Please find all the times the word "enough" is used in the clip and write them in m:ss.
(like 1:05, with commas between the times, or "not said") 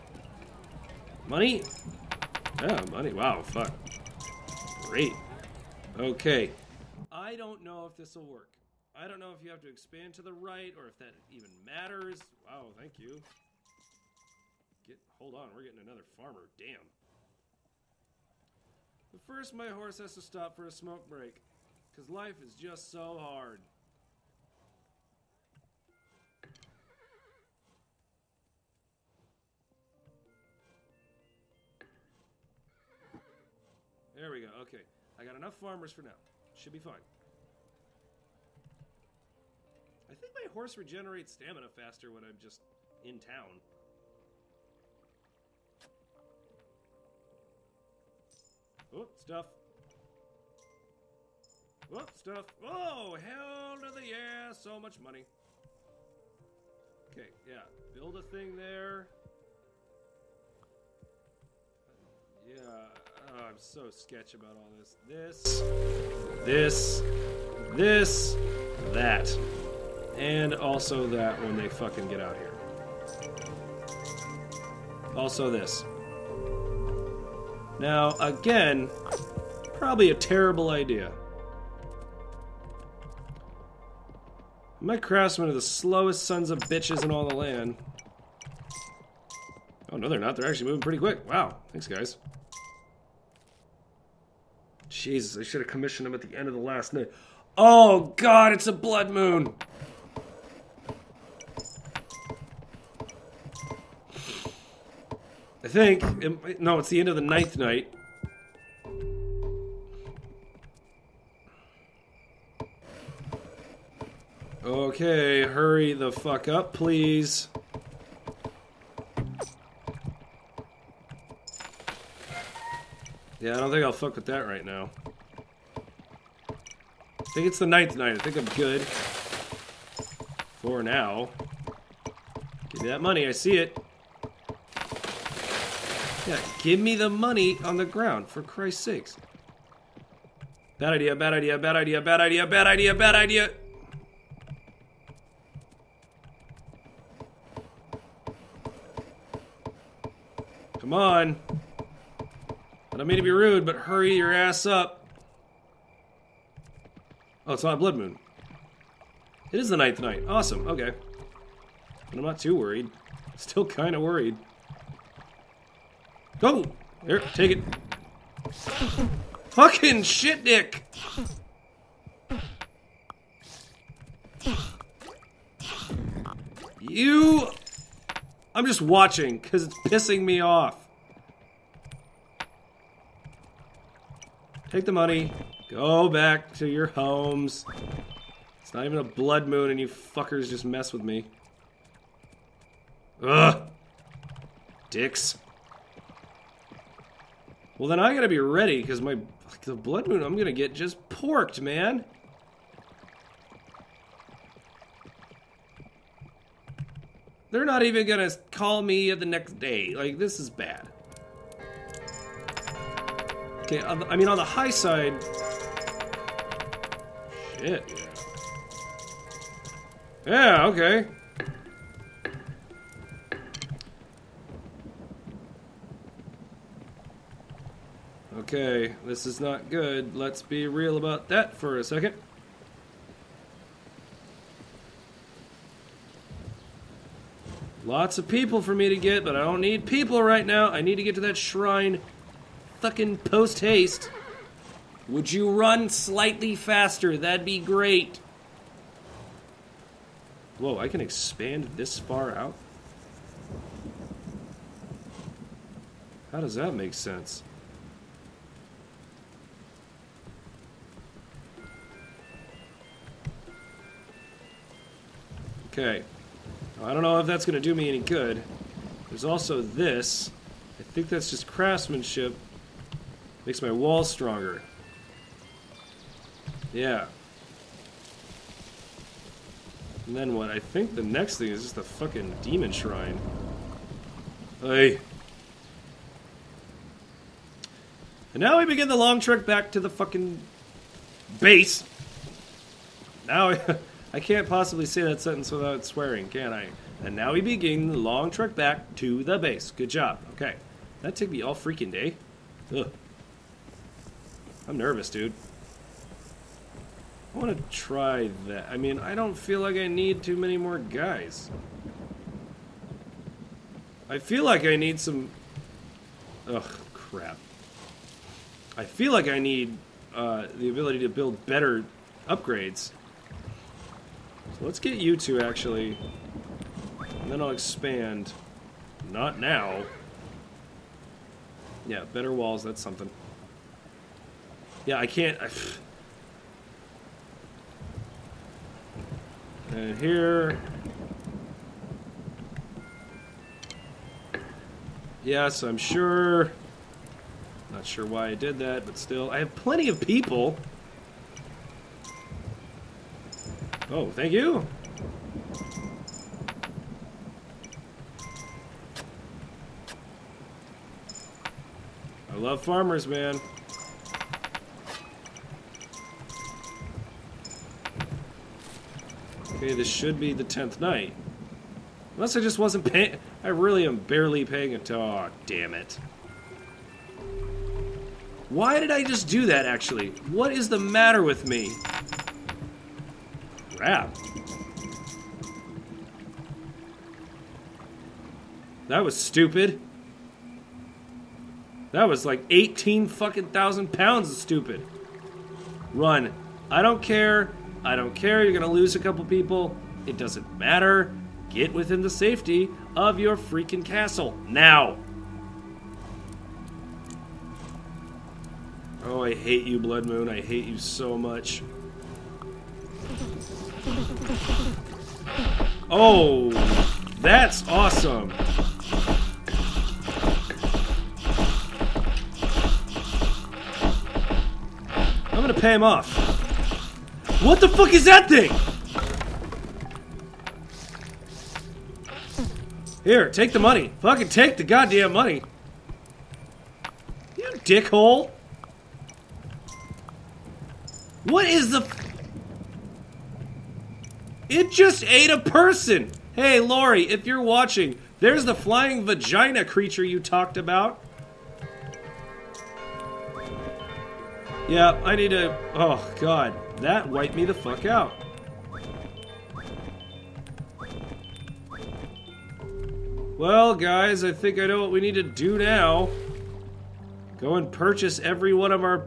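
0:35.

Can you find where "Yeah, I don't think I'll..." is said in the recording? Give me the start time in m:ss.
2:03.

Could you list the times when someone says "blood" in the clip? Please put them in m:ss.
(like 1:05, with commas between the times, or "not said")
1:38, 2:37, 3:09, 3:19, 6:49.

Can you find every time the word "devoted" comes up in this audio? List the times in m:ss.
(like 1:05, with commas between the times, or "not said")
not said.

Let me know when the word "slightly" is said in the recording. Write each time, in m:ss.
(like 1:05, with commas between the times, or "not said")
4:05.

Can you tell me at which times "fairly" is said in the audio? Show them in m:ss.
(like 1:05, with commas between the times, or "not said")
not said.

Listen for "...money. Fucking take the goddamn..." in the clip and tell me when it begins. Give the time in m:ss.
7:13.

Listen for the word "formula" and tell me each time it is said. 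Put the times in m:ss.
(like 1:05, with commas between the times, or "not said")
not said.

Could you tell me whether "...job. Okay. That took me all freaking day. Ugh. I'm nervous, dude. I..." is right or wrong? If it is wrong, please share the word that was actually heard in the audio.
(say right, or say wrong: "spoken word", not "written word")
right.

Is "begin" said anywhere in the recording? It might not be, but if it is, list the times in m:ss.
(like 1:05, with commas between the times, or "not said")
4:48, 4:57.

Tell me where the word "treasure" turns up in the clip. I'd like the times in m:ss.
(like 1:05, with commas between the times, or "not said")
not said.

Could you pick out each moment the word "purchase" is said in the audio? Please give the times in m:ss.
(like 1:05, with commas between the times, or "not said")
7:47.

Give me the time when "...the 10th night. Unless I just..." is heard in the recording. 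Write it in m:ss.
6:10.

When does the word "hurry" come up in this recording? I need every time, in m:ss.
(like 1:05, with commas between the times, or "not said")
1:55, 2:33.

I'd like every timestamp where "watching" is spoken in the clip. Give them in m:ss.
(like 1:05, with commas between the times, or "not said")
2:58, 7:27.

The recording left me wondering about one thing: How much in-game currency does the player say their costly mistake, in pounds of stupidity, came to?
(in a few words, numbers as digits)
18 thousand.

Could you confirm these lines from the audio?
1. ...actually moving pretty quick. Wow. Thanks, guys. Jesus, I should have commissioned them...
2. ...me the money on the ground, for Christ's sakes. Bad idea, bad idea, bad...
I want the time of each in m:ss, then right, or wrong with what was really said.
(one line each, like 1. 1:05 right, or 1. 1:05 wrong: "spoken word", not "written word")
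1. 1:30 right
2. 2:16 right.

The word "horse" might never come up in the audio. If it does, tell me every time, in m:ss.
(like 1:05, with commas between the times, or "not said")
0:19, 0:40.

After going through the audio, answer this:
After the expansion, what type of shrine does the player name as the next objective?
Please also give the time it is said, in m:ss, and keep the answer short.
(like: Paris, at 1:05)
demon shrine, at 4:42.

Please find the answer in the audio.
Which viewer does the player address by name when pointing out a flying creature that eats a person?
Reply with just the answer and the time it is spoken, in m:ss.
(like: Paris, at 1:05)
Lori, at 7:26.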